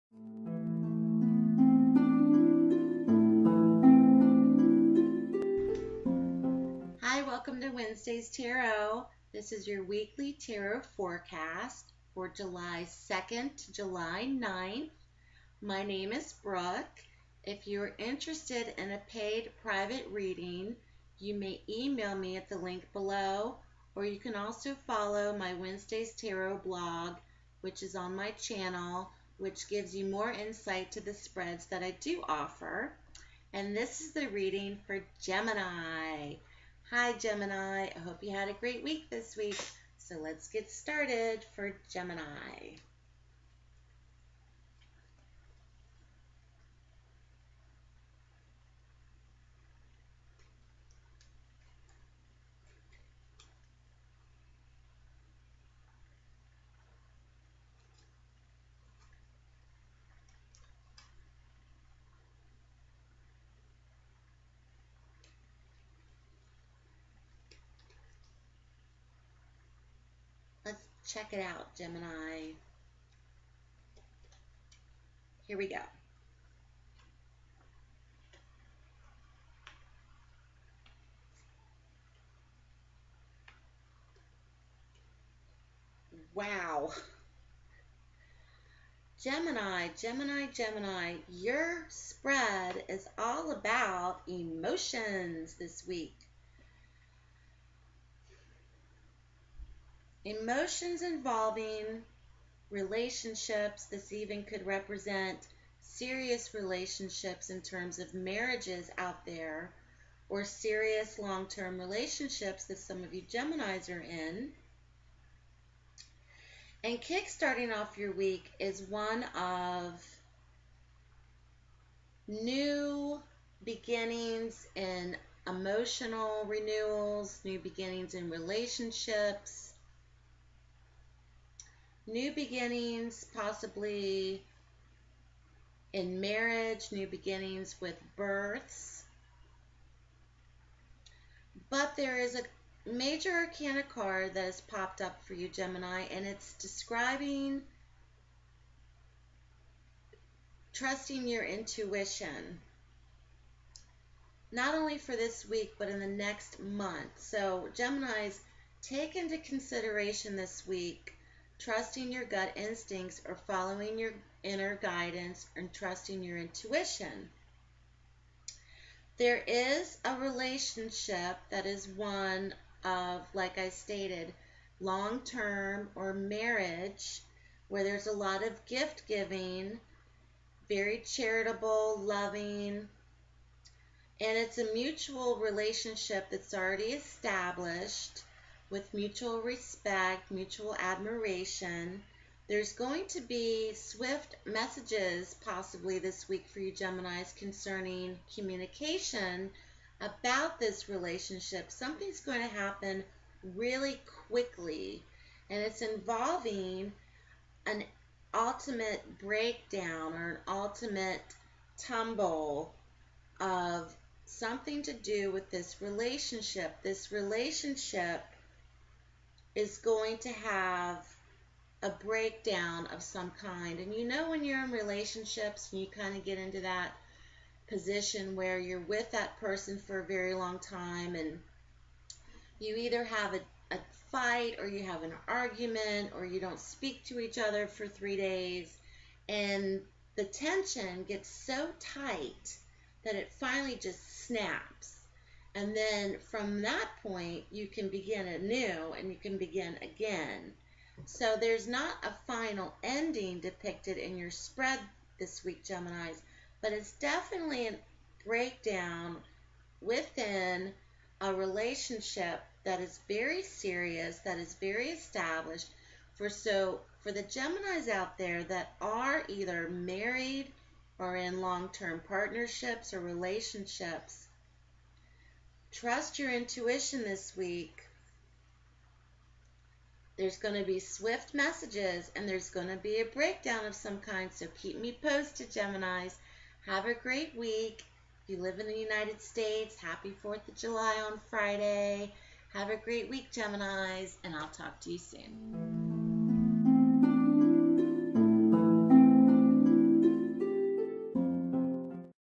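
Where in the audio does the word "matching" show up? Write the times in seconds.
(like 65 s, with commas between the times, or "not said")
not said.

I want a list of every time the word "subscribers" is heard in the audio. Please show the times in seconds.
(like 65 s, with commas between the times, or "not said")
not said.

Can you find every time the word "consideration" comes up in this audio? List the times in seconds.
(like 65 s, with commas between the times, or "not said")
159 s.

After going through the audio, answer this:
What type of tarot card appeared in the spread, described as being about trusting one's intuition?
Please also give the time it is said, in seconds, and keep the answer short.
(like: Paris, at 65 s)
major arcana, at 142 s.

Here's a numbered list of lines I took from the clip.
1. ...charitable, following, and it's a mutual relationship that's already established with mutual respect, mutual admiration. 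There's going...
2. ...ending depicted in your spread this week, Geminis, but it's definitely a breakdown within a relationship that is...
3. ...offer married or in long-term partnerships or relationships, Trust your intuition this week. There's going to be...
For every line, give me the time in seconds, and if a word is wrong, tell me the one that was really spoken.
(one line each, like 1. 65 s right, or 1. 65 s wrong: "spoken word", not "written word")
1. 181 s wrong: "loving", not "following"
2. 252 s right
3. 269 s wrong: "either", not "offer".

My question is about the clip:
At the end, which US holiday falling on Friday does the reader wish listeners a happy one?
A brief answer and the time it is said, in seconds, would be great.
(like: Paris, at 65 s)
4th of July, at 290 s.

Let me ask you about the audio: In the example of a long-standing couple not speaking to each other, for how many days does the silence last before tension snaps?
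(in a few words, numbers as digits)
3.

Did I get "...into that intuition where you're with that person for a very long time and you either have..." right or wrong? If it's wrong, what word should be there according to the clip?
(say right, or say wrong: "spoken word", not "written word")
wrong: "position", not "intuition".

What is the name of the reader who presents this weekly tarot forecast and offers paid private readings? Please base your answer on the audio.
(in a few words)
Brooke.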